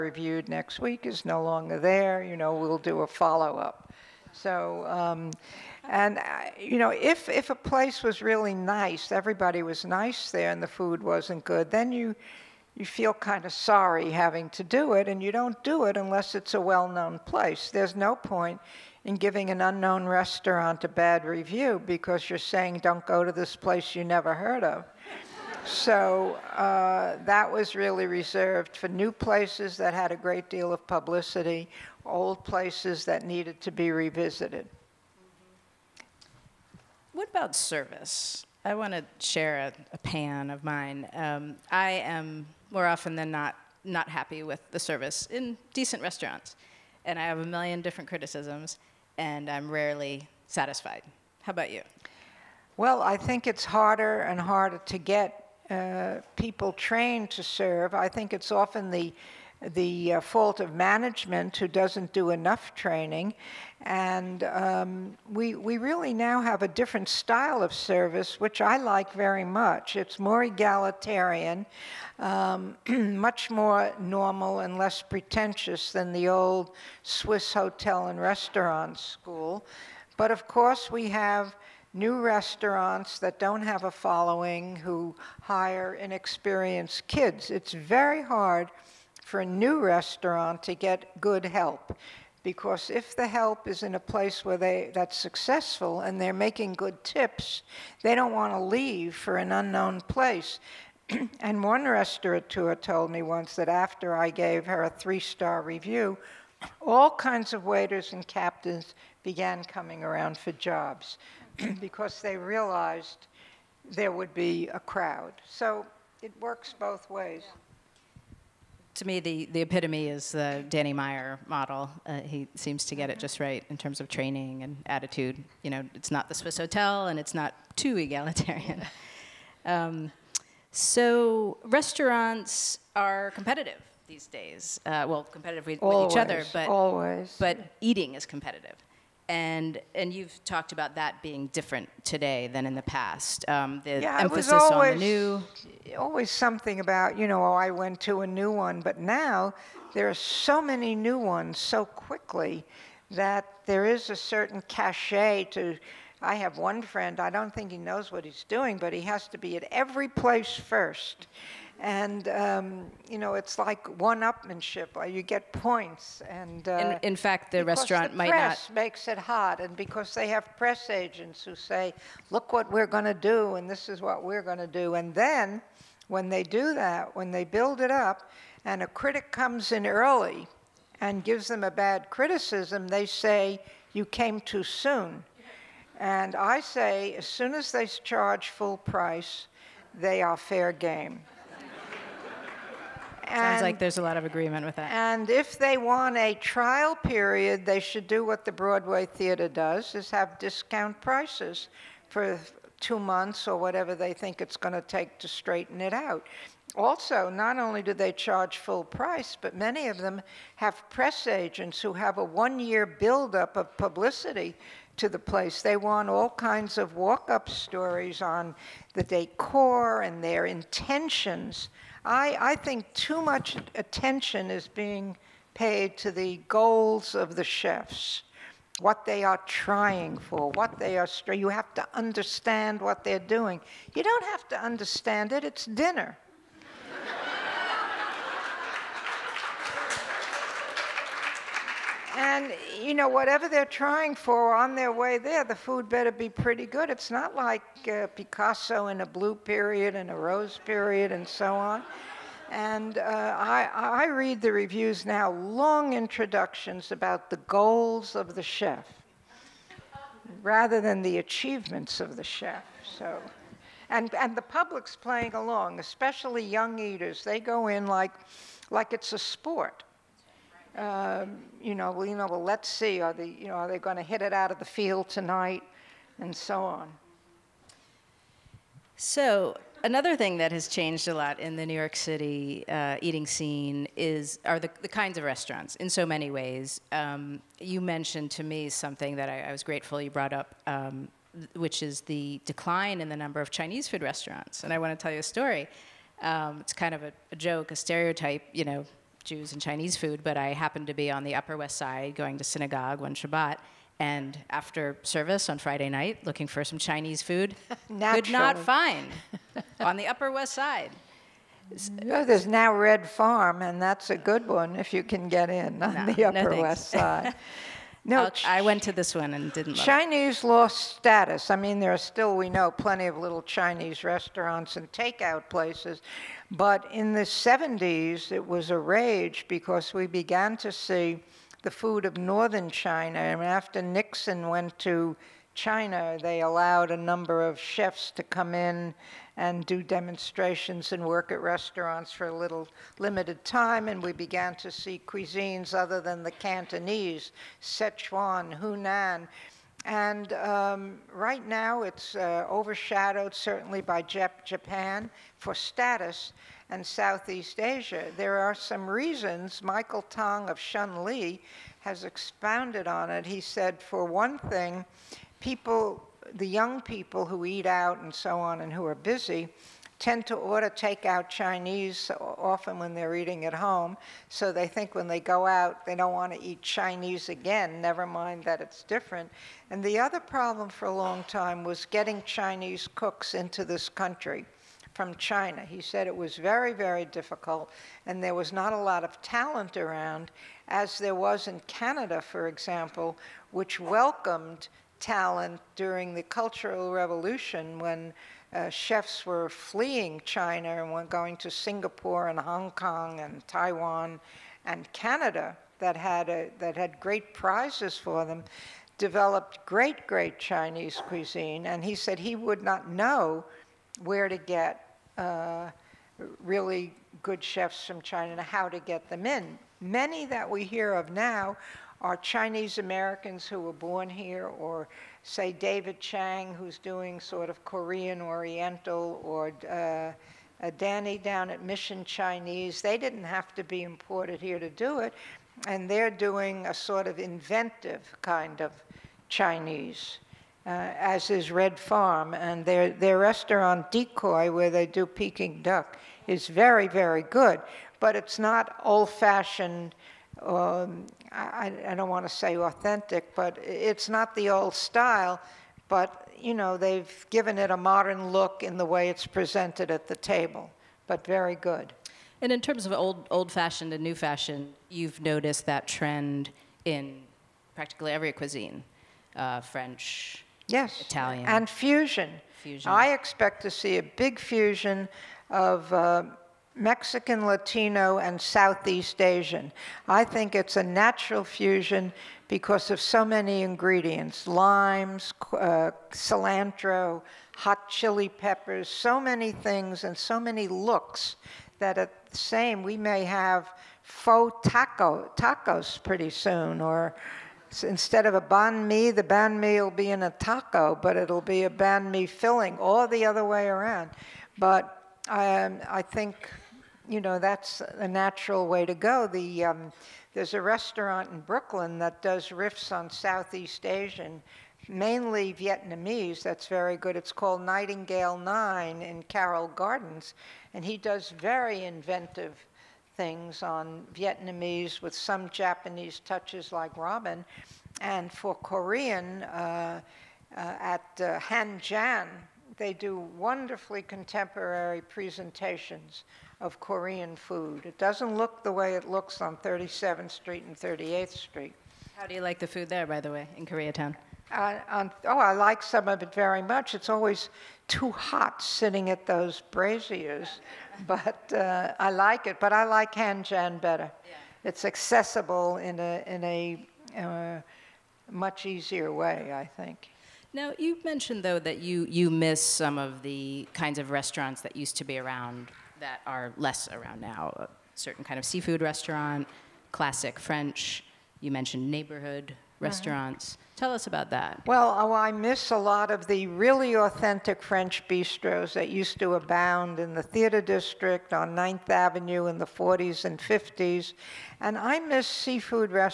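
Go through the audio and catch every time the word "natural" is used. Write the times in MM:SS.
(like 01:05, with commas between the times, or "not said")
08:00, 08:28.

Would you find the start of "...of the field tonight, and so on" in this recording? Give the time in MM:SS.
04:34.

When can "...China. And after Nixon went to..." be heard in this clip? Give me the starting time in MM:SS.
05:32.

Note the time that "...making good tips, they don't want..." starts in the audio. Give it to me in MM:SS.
01:36.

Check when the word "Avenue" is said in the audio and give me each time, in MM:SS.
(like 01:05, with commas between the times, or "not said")
09:41.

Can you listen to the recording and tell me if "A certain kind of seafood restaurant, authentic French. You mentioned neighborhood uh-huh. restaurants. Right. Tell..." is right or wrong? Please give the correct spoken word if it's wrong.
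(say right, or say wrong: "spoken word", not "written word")
wrong: "classic", not "authentic".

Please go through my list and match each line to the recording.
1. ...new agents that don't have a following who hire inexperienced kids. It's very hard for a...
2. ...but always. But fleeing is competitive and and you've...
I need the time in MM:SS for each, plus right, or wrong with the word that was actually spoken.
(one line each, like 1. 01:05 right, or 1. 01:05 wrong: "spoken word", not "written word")
1. 01:21 wrong: "restaurants", not "agents"
2. 02:16 wrong: "eating", not "fleeing".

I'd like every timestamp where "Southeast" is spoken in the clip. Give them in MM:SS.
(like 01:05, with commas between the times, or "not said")
05:56, 07:58, 08:33.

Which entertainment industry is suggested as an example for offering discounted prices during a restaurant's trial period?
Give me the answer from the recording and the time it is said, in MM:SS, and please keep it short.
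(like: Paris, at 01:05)
Broadway Theater, at 03:18.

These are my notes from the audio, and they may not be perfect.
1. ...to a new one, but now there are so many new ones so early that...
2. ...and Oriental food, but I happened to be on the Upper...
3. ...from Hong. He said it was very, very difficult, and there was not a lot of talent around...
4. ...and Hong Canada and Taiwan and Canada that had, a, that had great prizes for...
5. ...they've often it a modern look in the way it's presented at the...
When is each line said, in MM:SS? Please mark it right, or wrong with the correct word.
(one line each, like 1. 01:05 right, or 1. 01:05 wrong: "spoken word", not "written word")
1. 02:28 wrong: "quickly", not "early"
2. 04:59 wrong: "Chinese", not "Oriental"
3. 06:24 wrong: "China", not "Hong"
4. 06:42 wrong: "Kong", not "Canada"
5. 07:36 wrong: "given", not "often".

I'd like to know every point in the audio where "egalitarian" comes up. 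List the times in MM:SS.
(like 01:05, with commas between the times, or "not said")
01:10, 02:07.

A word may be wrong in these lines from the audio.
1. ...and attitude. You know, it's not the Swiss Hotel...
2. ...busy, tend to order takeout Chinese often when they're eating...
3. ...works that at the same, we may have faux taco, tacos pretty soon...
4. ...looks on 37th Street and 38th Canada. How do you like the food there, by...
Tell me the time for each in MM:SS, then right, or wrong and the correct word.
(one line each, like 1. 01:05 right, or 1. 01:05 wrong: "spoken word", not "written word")
1. 02:04 right
2. 06:08 right
3. 08:10 wrong: "looks", not "works"
4. 08:59 wrong: "Street", not "Canada".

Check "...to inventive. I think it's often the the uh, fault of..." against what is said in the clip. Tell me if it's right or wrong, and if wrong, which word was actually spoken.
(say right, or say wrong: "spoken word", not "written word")
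wrong: "serve", not "inventive".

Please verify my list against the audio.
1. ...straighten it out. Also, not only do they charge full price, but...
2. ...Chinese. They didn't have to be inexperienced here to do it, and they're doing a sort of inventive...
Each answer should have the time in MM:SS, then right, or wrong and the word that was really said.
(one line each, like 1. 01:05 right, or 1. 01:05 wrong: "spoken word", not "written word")
1. 03:25 right
2. 07:12 wrong: "imported", not "inexperienced".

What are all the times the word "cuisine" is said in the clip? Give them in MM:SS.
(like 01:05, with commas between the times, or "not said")
05:45, 06:51, 07:48.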